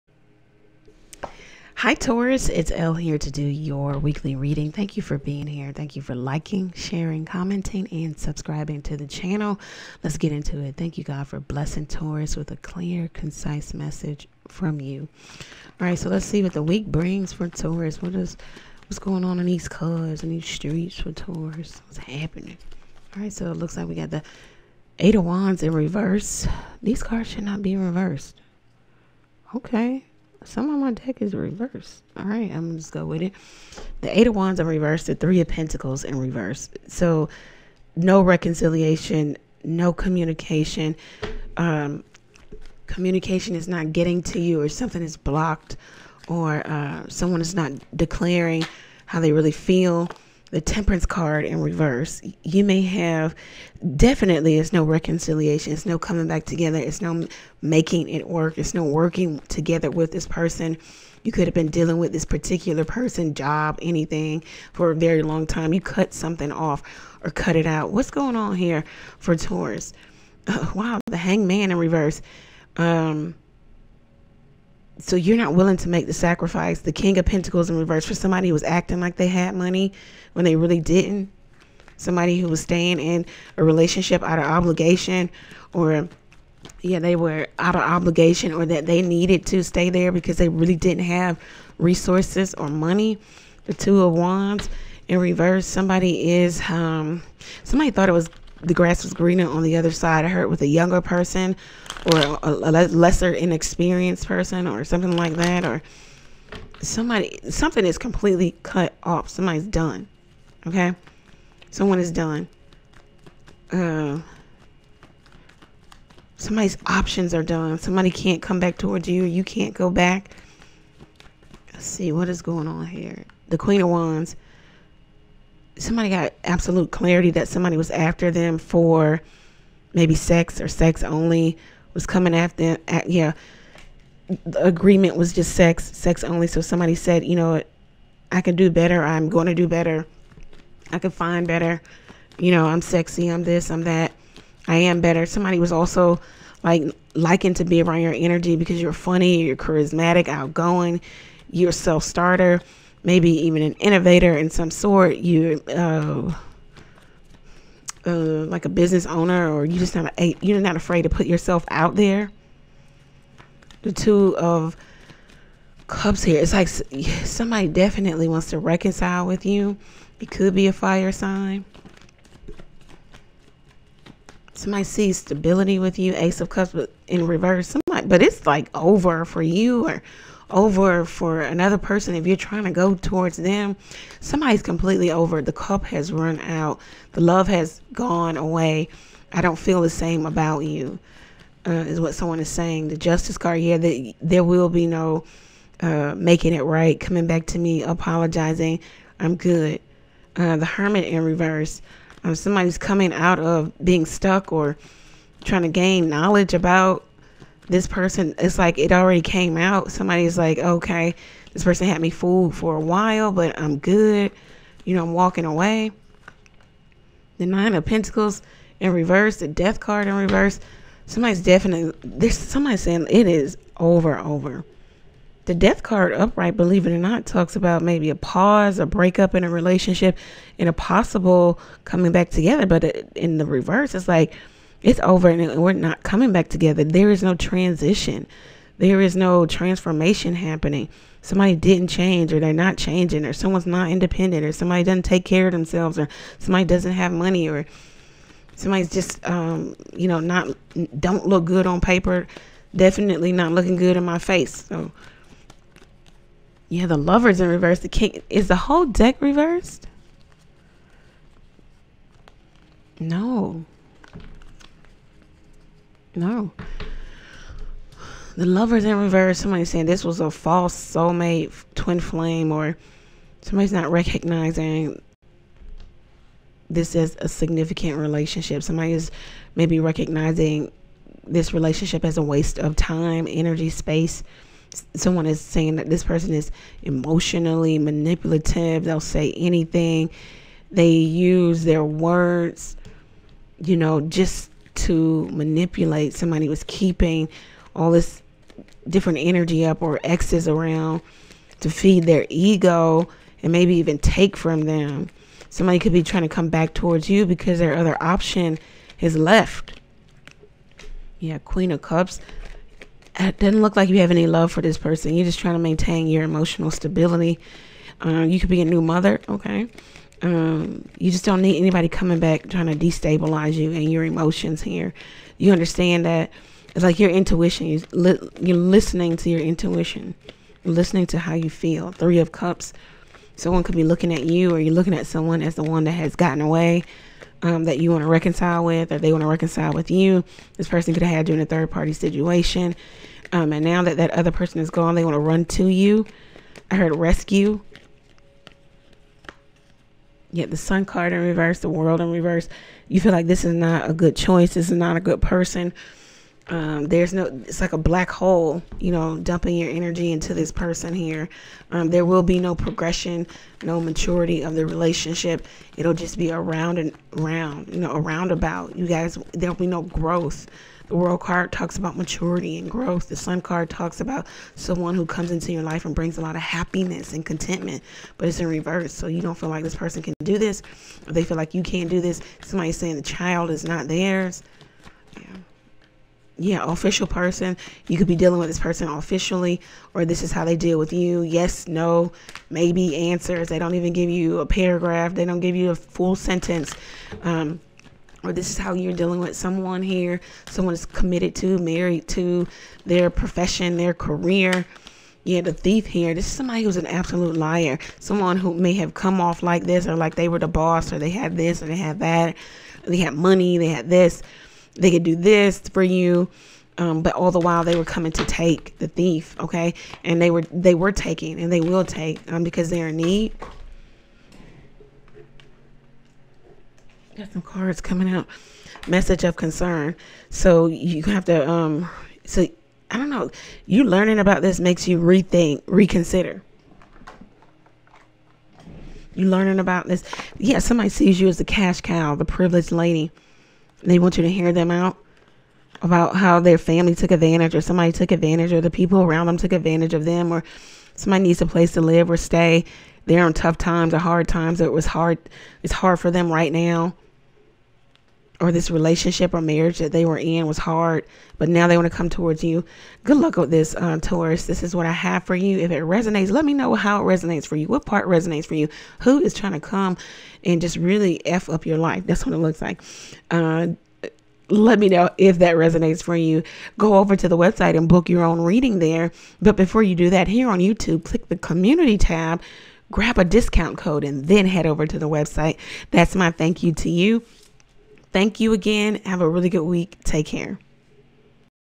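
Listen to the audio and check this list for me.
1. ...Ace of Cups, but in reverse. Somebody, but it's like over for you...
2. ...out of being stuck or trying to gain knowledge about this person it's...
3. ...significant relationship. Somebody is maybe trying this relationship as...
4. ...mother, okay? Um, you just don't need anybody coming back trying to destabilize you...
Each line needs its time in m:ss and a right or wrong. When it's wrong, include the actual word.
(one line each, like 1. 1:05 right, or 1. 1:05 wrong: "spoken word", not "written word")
1. 2:56 right
2. 3:23 right
3. 4:37 wrong: "recognizing", not "trying"
4. 5:18 right.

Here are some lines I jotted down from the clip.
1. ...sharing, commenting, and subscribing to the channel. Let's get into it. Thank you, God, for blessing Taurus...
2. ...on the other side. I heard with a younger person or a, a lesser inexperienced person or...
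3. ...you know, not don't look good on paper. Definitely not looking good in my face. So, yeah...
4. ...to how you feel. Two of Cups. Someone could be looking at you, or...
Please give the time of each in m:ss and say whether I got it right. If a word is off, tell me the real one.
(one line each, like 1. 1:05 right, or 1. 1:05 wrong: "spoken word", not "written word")
1. 0:06 right
2. 1:39 right
3. 4:09 right
4. 5:31 wrong: "Three", not "Two".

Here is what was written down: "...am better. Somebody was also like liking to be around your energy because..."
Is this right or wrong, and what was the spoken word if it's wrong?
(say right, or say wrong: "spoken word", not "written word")
right.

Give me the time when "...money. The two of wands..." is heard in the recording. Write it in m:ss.
1:32.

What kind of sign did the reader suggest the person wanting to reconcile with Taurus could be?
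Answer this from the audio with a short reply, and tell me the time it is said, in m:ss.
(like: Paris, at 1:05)
fire sign, at 2:50.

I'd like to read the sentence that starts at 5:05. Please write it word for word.
Somebody could be trying to come back towards you because their other option is left.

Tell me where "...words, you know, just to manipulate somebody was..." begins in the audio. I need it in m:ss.
4:51.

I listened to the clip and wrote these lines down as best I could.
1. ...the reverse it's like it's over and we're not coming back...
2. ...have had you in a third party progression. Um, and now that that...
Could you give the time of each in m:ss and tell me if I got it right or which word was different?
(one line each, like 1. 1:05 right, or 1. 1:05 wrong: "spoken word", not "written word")
1. 3:53 right
2. 5:41 wrong: "situation", not "progression".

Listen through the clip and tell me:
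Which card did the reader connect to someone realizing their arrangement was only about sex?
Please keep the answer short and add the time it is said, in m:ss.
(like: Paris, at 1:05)
Queen of Wands, at 2:03.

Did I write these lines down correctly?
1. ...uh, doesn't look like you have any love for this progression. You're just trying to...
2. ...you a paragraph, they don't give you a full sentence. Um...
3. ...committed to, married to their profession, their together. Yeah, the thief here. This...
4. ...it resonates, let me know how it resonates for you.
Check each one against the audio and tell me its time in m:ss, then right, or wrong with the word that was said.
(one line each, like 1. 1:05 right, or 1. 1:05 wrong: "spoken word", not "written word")
1. 5:13 wrong: "person", not "progression"
2. 6:34 right
3. 6:40 wrong: "career", not "together"
4. 7:45 right.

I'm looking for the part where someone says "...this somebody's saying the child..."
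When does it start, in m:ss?
6:22.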